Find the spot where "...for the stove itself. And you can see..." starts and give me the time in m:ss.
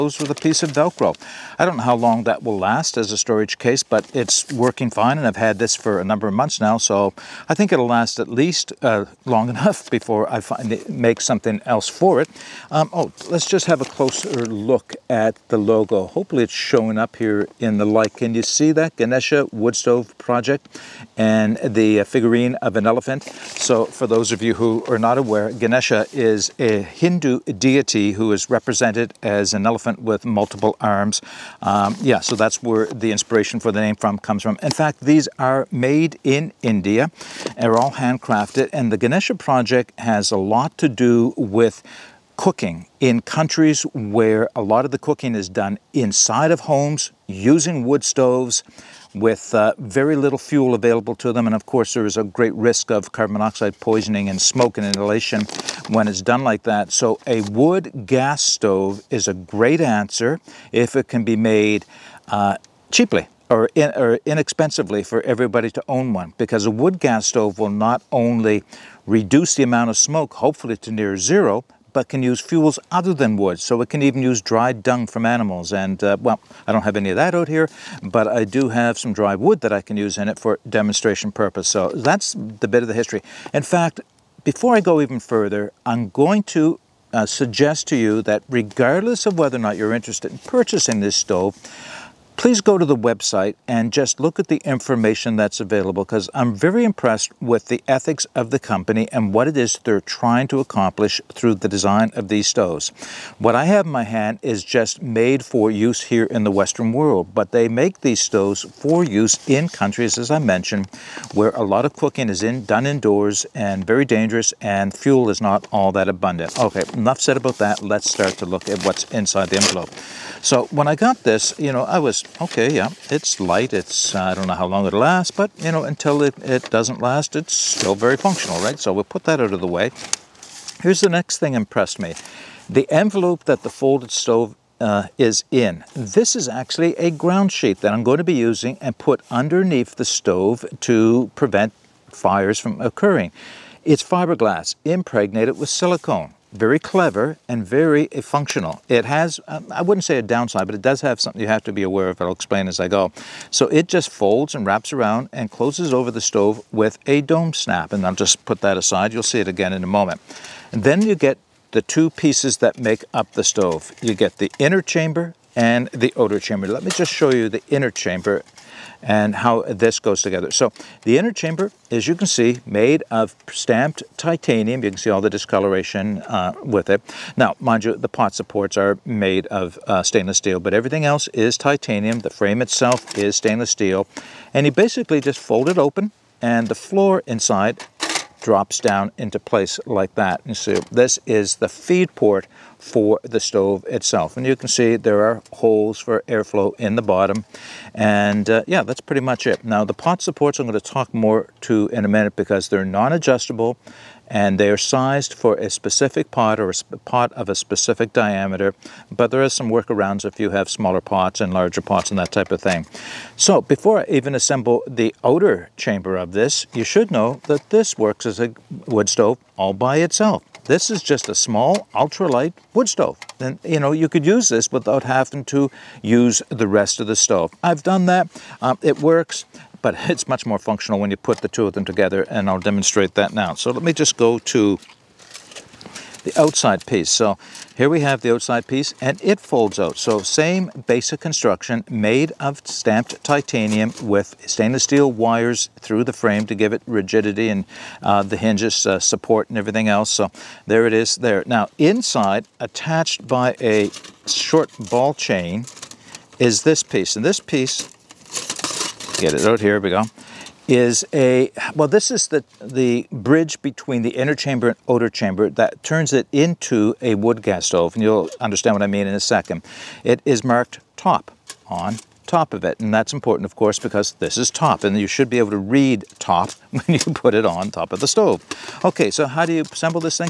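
3:12.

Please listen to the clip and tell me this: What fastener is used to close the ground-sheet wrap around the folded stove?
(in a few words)
dome snap.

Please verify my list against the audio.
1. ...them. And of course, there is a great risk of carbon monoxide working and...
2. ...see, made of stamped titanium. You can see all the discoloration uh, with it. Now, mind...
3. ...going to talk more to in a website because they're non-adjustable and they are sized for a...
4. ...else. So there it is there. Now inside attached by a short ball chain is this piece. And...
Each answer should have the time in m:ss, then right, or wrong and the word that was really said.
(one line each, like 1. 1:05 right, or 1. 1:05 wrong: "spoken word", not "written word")
1. 0:51 wrong: "poisoning", not "working"
2. 2:52 right
3. 3:20 wrong: "minute", not "website"
4. 4:09 right.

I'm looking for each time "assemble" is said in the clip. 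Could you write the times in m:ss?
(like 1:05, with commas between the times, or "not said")
3:34, 4:39.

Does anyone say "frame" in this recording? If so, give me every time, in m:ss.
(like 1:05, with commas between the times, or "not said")
3:02, 4:06.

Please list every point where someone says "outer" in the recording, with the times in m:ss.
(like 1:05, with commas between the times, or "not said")
2:46, 3:35, 4:24.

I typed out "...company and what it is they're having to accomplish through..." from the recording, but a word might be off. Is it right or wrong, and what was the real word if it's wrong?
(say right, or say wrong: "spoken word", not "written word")
wrong: "trying", not "having".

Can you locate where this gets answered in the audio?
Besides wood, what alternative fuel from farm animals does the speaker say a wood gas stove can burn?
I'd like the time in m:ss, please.
1:14.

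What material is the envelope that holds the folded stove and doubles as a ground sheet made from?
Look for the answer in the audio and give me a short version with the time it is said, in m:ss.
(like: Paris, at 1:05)
fiberglass impregnated with silicone, at 2:24.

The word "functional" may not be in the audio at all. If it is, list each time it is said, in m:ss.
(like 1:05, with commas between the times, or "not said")
2:08, 2:28, 3:50.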